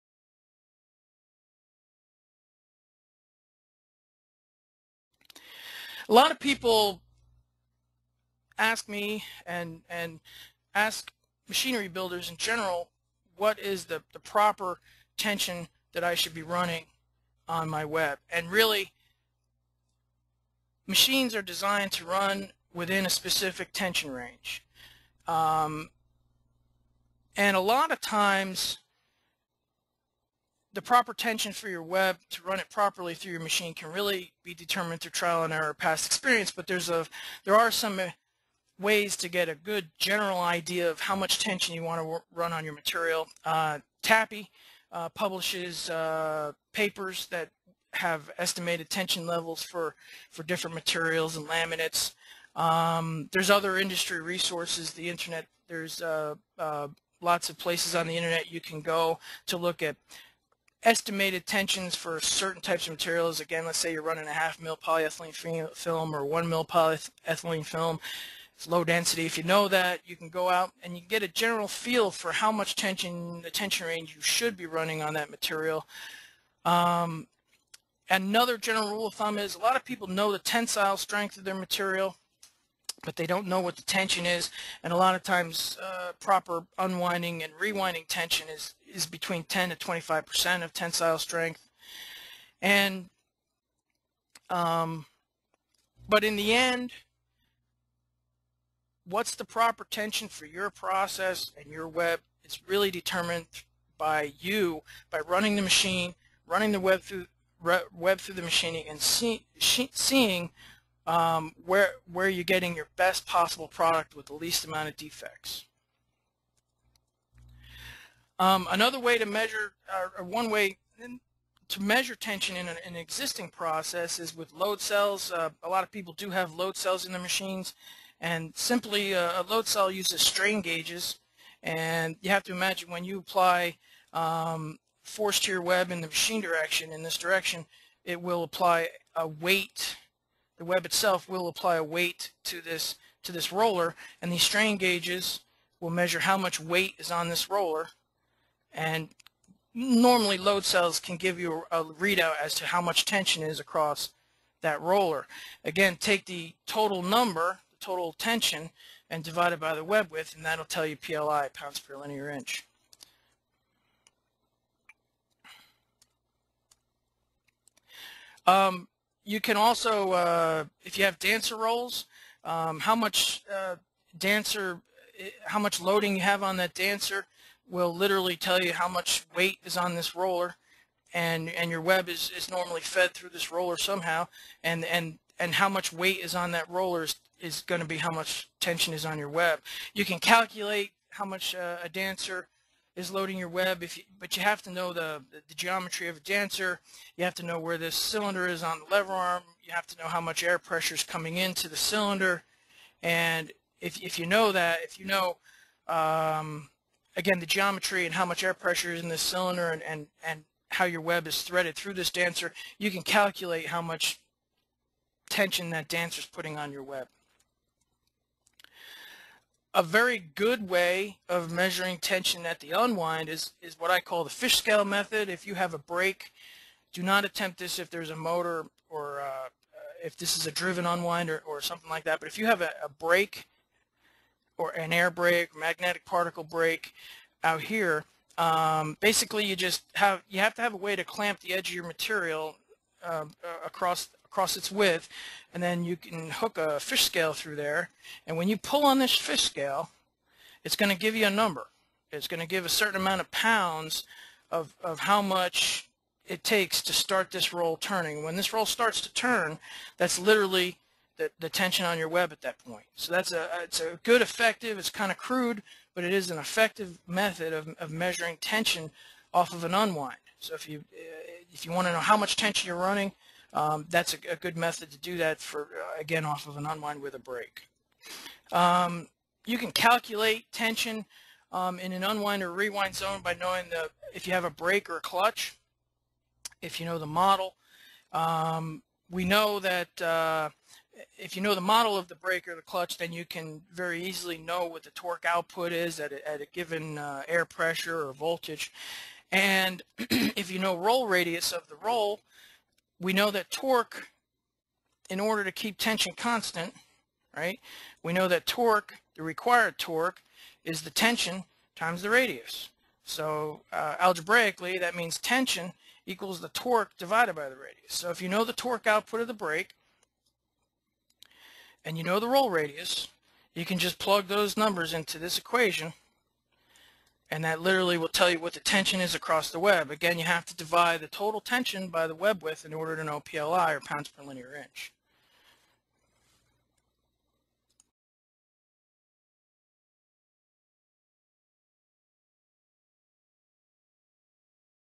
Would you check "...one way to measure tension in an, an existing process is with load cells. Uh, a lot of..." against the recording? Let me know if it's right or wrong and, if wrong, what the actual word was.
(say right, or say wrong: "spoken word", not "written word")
right.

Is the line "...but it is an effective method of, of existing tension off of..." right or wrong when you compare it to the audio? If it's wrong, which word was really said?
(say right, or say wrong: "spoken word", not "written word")
wrong: "measuring", not "existing".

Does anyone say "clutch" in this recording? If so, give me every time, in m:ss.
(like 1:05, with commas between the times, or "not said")
4:45, 4:52.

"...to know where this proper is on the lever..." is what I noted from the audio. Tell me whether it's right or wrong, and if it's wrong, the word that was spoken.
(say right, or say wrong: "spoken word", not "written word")
wrong: "cylinder", not "proper".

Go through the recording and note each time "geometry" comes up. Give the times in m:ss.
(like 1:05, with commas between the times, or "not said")
3:15, 3:27.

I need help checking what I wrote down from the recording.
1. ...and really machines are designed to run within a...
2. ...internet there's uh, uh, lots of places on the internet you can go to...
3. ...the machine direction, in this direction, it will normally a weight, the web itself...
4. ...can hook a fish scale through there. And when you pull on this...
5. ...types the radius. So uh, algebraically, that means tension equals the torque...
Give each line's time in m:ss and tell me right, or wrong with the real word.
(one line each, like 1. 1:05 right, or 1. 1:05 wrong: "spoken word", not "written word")
1. 0:18 right
2. 0:55 right
3. 2:16 wrong: "apply", not "normally"
4. 4:05 right
5. 5:11 wrong: "times", not "types".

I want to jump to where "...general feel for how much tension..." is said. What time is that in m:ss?
1:11.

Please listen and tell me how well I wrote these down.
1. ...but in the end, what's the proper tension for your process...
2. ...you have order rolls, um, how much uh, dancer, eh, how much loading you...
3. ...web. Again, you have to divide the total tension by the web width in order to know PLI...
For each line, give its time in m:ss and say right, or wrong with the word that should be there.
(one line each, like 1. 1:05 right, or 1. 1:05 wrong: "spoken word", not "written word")
1. 1:36 right
2. 2:50 wrong: "dancer", not "order"
3. 5:29 right.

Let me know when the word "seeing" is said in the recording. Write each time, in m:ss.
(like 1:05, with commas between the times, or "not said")
1:49.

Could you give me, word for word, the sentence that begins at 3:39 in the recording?
A very good way of measuring tension at the unwind is, is what I call the fish scale method.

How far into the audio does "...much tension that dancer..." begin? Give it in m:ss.
3:33.